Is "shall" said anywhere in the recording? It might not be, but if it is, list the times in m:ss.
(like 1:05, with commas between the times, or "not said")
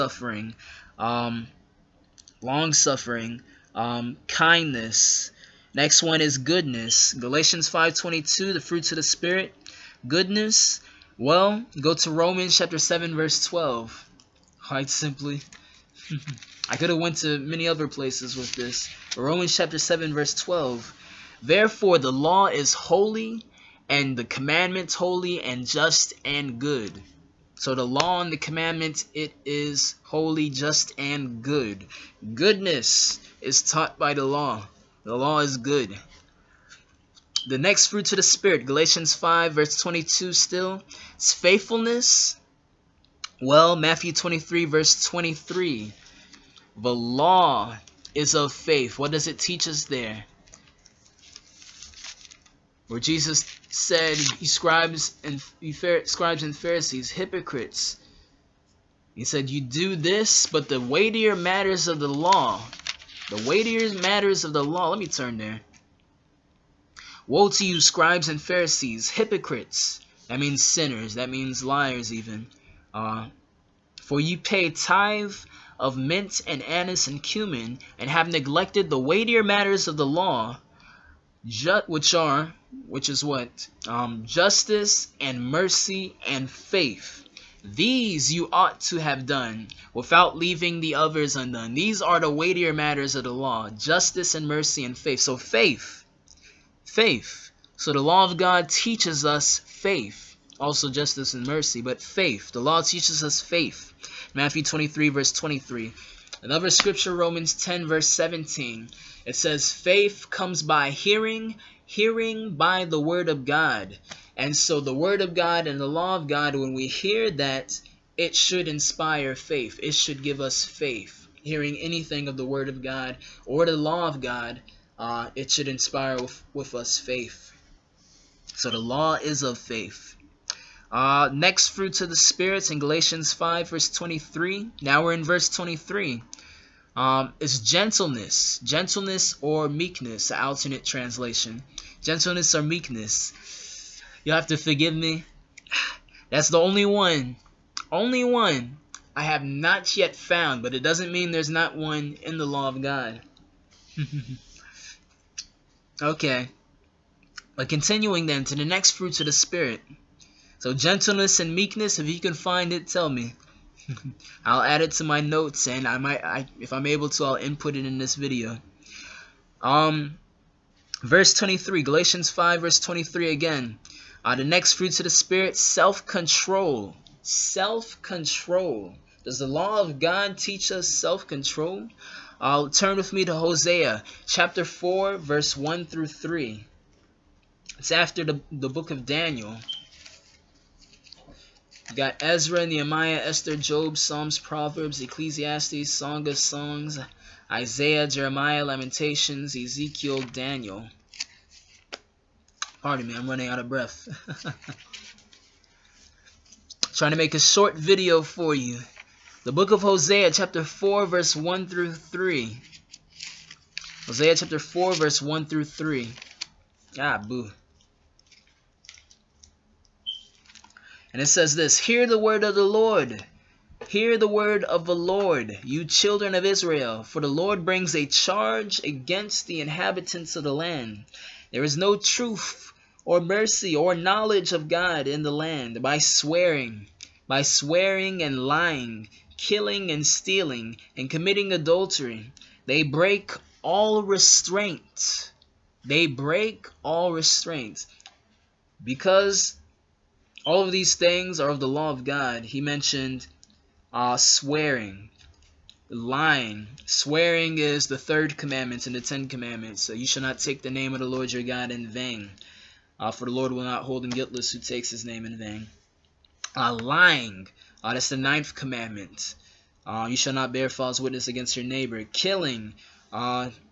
4:20, 4:30.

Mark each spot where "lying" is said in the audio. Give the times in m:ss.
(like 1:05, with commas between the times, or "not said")
3:58, 4:15, 4:26.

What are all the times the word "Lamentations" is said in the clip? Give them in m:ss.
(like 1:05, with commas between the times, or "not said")
3:18.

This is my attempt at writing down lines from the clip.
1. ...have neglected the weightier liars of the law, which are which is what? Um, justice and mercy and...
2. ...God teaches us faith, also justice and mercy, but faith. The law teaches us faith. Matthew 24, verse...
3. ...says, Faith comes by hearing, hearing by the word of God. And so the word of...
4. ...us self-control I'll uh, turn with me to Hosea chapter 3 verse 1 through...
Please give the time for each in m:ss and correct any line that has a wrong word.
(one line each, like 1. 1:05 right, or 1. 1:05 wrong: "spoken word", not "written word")
1. 1:18 wrong: "matters", not "liars"
2. 1:38 wrong: "23", not "24"
3. 1:49 right
4. 3:00 wrong: "4", not "3".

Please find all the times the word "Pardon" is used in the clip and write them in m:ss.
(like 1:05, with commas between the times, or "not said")
3:22.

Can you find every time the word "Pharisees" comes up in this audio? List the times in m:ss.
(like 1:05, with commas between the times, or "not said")
0:56, 1:08.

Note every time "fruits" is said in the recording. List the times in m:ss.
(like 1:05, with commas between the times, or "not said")
0:08, 0:37, 2:11, 2:38, 2:54.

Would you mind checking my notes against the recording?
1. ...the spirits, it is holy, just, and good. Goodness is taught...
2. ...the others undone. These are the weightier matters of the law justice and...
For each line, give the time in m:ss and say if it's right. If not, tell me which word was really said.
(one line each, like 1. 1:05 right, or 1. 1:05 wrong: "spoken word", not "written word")
1. 0:28 wrong: "commandments", not "spirits"
2. 1:30 right.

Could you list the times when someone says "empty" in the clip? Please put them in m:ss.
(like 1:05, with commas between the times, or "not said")
not said.